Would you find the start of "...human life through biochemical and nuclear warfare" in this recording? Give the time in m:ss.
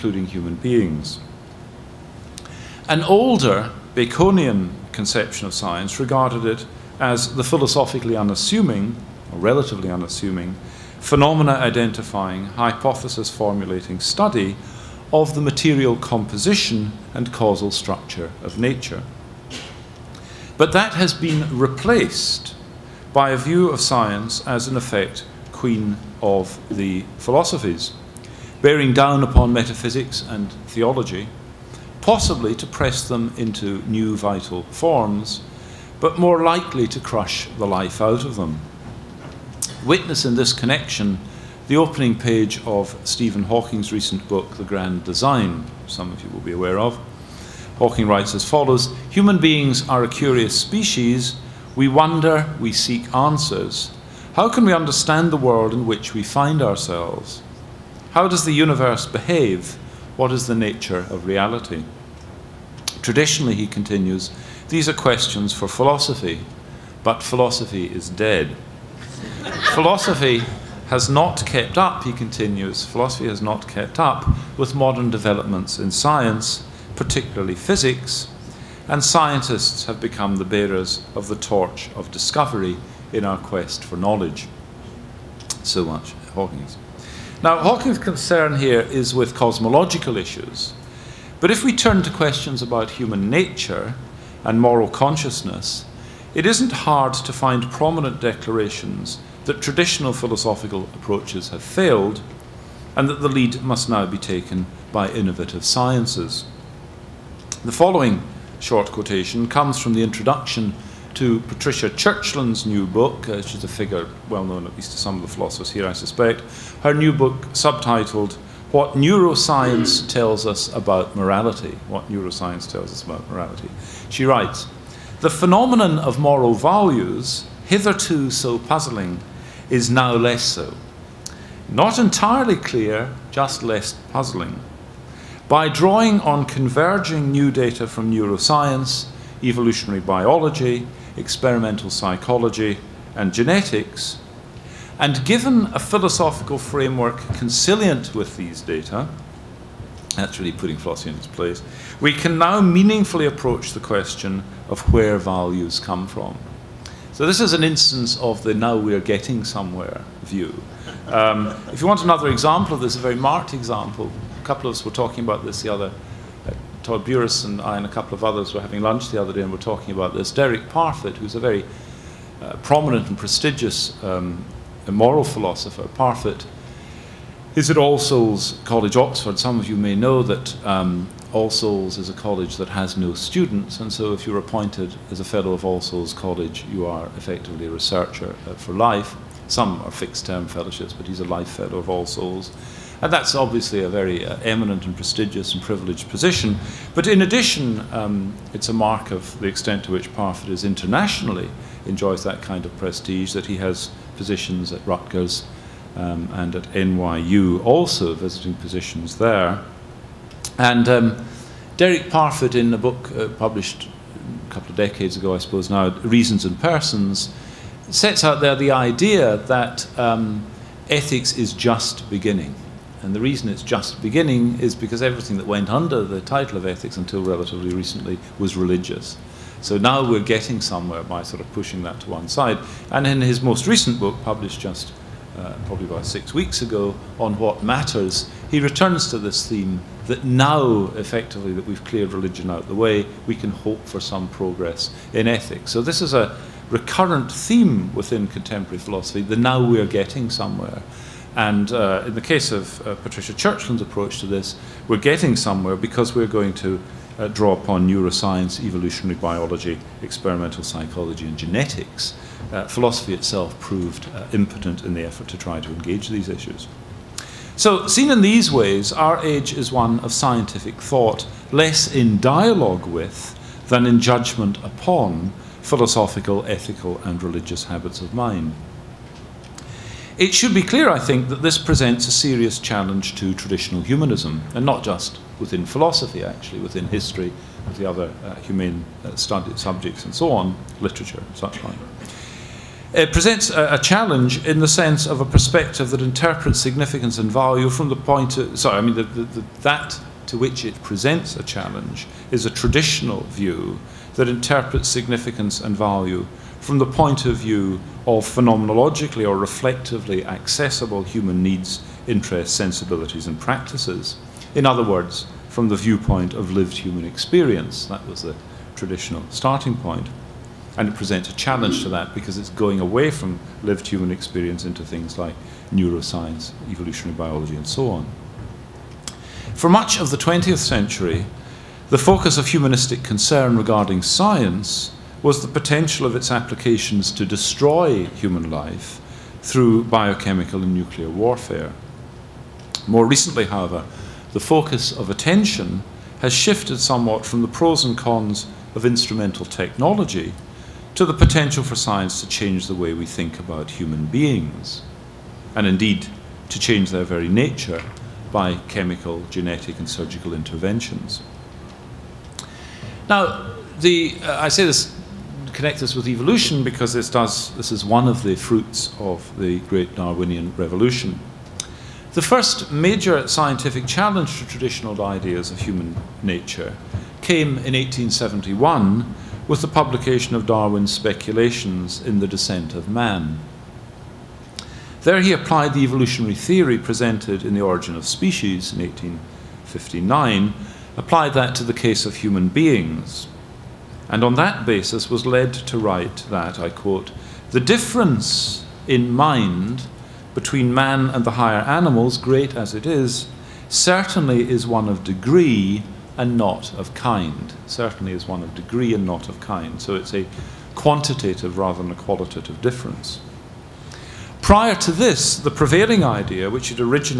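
5:38.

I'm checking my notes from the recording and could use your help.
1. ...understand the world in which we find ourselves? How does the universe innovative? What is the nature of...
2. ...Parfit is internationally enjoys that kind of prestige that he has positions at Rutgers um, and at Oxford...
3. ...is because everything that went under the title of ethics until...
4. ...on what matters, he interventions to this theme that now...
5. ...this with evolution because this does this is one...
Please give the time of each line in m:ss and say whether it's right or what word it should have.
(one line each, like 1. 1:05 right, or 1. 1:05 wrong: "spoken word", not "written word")
1. 0:54 wrong: "behave", not "innovative"
2. 3:20 wrong: "NYU", not "Oxford"
3. 3:44 right
4. 3:57 wrong: "returns", not "interventions"
5. 6:05 right.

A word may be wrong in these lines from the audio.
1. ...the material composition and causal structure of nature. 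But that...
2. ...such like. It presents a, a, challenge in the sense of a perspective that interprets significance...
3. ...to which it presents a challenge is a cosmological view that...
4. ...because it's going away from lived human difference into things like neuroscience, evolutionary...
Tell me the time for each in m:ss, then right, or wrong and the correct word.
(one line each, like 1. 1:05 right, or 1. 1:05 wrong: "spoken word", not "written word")
1. 0:15 right
2. 4:51 right
3. 5:00 wrong: "traditional", not "cosmological"
4. 5:22 wrong: "experience", not "difference".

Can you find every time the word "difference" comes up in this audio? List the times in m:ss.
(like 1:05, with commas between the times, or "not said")
6:37, 6:52.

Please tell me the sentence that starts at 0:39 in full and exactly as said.
Witness in this connection the opening page of Stephen Hawking's recent book, The Grand Design, some of you will be aware of.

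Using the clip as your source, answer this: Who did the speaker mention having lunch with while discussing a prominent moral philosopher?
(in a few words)
Todd Buras.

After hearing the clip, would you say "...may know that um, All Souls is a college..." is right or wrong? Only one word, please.
right.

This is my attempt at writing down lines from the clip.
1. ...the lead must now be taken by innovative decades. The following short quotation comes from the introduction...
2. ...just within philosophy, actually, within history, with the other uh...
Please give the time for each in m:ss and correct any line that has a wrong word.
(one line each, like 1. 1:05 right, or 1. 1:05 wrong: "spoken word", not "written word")
1. 1:43 wrong: "sciences", not "decades"
2. 4:44 right.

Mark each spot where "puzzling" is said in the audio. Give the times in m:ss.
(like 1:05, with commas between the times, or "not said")
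2:08, 2:14.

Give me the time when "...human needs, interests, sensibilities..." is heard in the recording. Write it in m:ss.
5:11.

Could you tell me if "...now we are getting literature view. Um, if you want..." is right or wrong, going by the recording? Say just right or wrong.
wrong.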